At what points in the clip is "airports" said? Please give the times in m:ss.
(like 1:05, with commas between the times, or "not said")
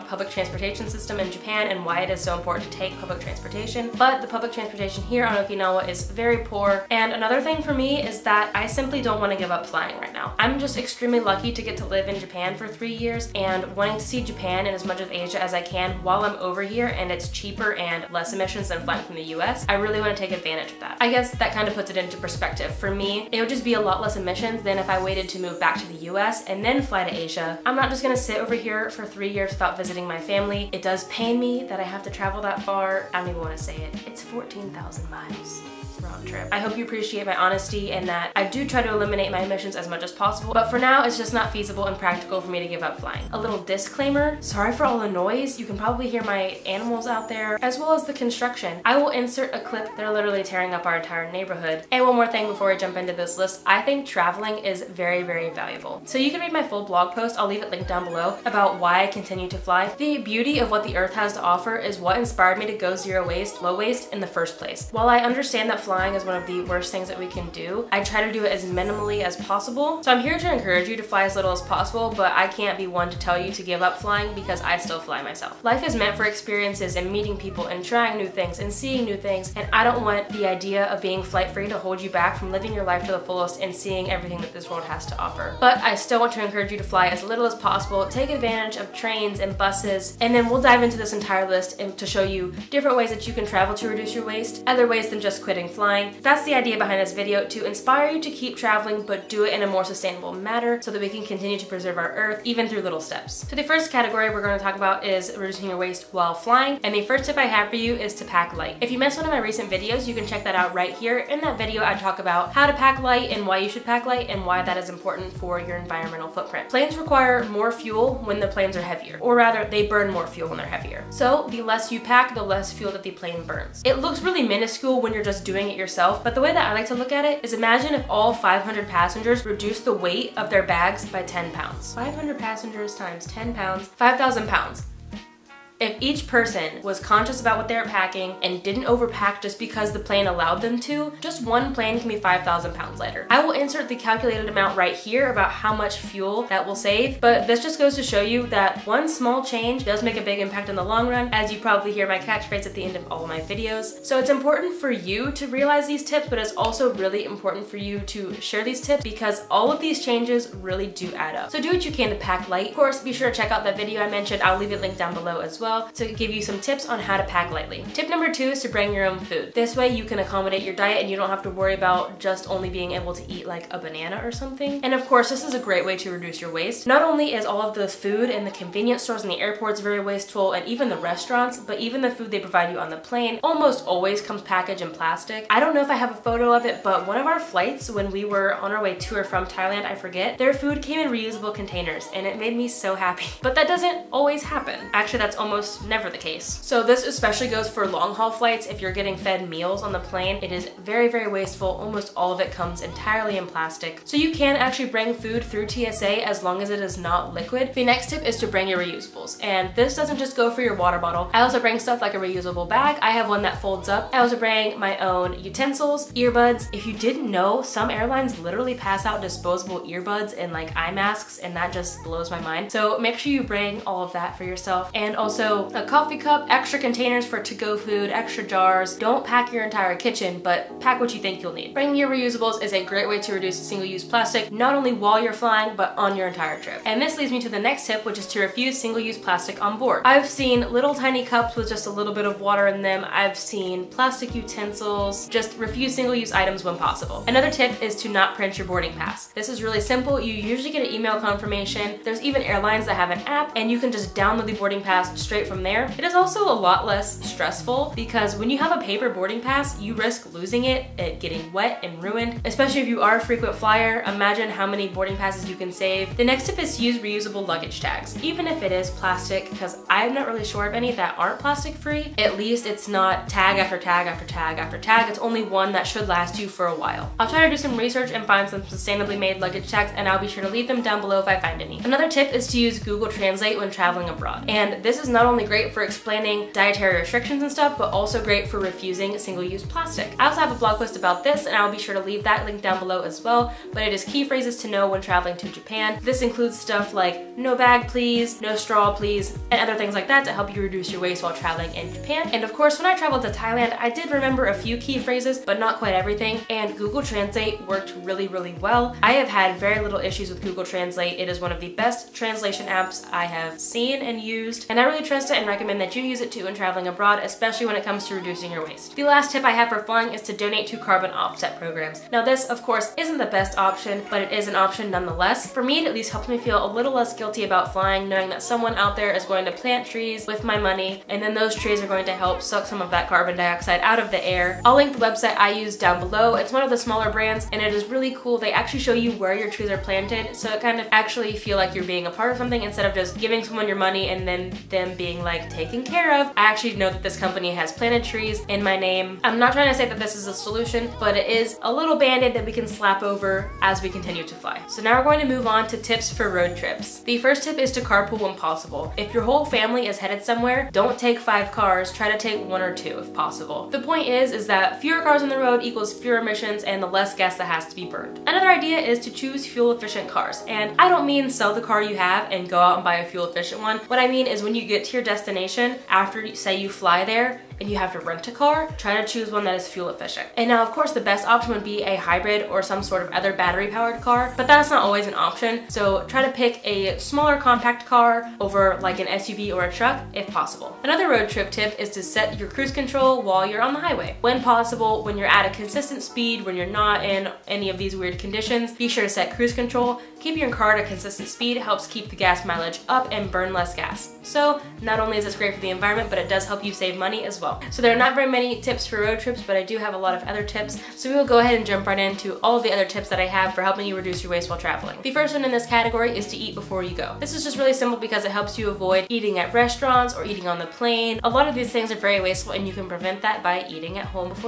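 2:59.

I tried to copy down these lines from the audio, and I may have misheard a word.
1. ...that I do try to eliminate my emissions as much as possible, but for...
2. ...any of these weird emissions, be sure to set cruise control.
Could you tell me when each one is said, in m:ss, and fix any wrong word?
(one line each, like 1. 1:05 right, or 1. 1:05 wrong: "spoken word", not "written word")
1. 0:38 right
2. 6:37 wrong: "conditions", not "emissions".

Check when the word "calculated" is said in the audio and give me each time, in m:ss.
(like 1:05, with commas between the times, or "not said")
2:23.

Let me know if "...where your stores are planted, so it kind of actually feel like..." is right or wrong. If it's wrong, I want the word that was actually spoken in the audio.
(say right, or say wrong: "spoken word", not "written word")
wrong: "trees", not "stores".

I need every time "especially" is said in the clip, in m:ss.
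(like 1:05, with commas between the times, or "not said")
3:17, 4:22, 5:17.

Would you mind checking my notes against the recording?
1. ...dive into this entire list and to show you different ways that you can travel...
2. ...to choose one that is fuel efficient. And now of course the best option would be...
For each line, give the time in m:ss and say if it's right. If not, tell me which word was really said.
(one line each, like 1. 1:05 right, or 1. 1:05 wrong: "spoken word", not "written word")
1. 1:30 right
2. 6:19 right.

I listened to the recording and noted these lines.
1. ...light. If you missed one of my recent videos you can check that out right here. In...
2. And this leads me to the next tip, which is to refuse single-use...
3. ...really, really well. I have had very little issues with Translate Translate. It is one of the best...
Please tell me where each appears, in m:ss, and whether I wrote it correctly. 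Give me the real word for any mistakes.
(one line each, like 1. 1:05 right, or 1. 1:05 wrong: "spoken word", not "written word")
1. 1:48 right
2. 3:56 right
3. 5:08 wrong: "Google", not "Translate".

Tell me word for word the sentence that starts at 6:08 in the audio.
Another idea is to choose fuel efficient cars.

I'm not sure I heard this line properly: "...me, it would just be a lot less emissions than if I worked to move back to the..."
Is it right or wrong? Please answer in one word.
wrong.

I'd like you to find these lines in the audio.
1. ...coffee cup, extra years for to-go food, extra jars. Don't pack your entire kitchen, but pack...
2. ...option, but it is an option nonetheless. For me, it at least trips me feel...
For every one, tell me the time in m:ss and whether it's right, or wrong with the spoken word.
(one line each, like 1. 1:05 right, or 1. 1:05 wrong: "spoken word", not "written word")
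1. 3:45 wrong: "containers", not "years"
2. 5:23 wrong: "helps", not "trips".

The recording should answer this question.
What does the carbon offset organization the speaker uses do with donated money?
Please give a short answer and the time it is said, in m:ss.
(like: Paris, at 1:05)
plant trees, at 5:29.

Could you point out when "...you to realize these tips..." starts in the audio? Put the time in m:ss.
2:34.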